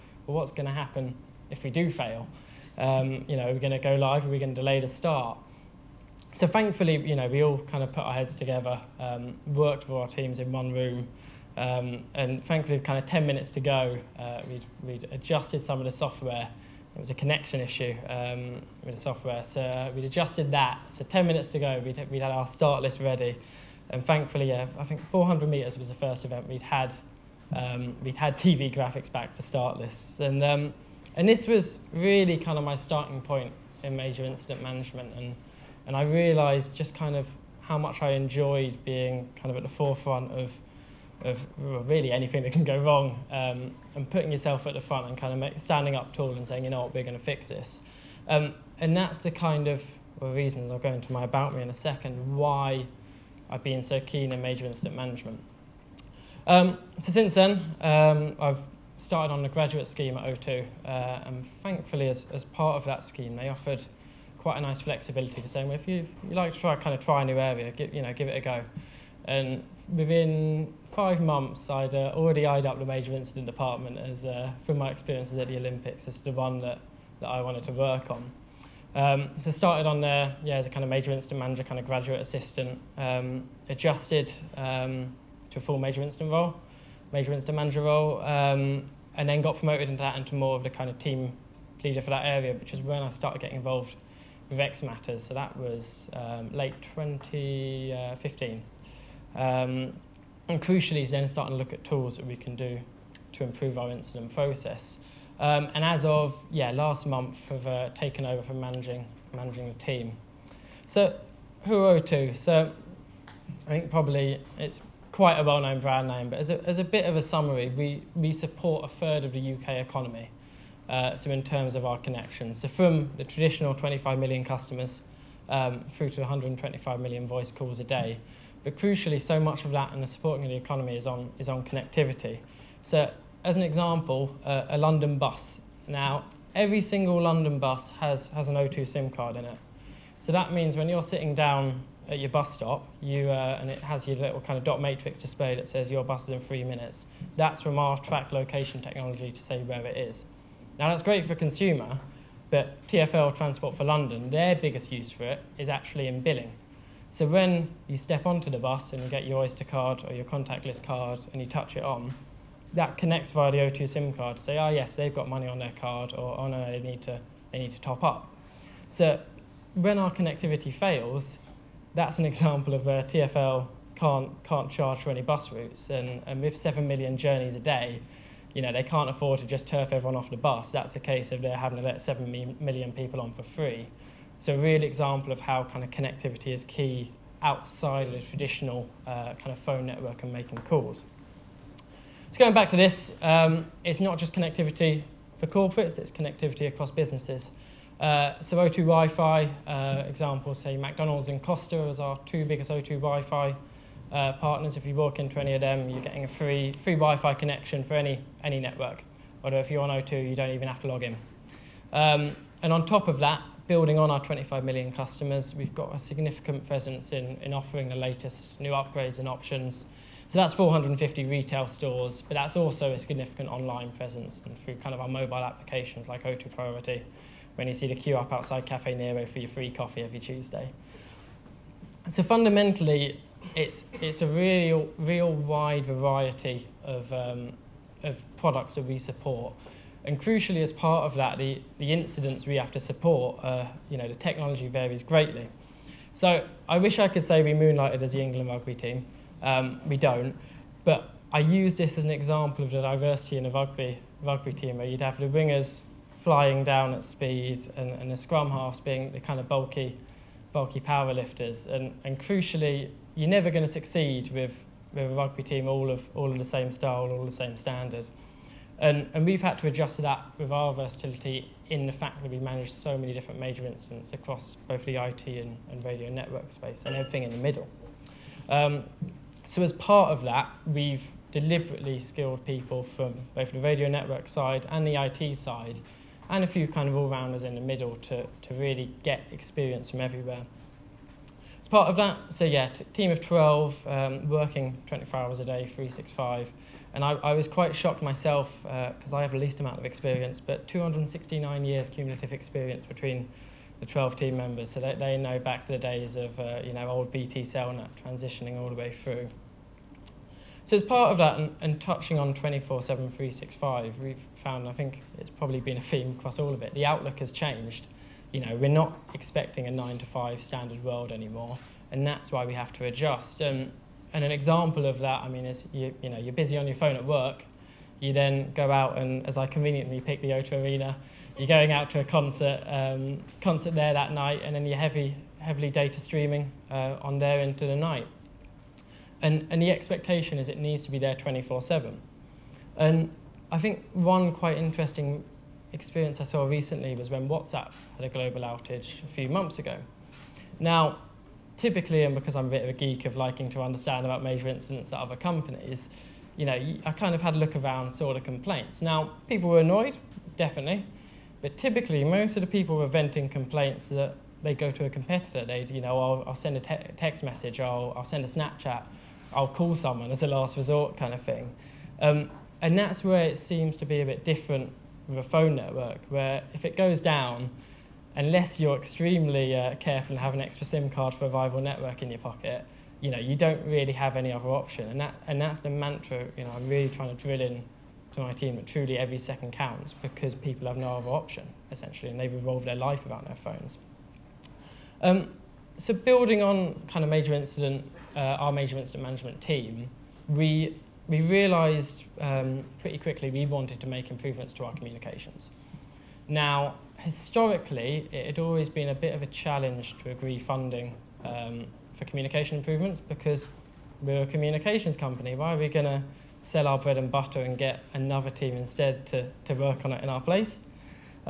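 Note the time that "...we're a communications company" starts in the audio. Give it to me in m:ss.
6:54.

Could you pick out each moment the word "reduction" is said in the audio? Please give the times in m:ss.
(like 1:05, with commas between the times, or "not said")
not said.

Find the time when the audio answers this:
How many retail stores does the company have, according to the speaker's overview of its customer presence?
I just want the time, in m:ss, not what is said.
3:40.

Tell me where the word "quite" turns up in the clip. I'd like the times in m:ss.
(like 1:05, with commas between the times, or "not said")
1:04, 1:55, 4:57, 5:44.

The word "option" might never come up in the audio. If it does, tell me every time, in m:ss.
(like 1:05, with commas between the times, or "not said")
3:39, 6:24, 6:31.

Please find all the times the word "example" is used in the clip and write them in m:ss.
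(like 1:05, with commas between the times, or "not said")
2:13, 2:52, 3:04, 3:20, 4:12, 5:24.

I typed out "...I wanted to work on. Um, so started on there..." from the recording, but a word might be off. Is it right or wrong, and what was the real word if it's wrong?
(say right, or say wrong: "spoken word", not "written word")
right.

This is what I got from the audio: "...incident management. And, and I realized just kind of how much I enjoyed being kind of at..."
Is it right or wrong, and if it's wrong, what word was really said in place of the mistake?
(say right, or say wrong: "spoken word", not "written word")
right.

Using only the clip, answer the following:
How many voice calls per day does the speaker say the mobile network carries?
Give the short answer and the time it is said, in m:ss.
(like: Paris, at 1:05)
125 million, at 2:06.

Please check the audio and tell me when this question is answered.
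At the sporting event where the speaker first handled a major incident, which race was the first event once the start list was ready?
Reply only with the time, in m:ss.
0:25.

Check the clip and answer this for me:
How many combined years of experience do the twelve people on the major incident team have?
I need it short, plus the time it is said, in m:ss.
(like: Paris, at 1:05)
269 years, at 5:00.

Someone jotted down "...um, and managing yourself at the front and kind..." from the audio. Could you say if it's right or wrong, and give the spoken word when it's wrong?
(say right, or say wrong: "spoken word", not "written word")
wrong: "putting", not "managing".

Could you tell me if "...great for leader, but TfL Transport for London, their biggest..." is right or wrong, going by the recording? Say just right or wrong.
wrong.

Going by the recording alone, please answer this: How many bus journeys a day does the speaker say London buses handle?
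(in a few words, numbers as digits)
7 million.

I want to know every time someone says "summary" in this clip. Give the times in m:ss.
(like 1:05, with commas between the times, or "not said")
1:57.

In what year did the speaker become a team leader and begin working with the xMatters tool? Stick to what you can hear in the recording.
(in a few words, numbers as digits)
2015.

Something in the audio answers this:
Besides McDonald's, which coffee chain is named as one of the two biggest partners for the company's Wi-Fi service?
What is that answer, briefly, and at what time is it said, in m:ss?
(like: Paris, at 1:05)
Costa, at 3:21.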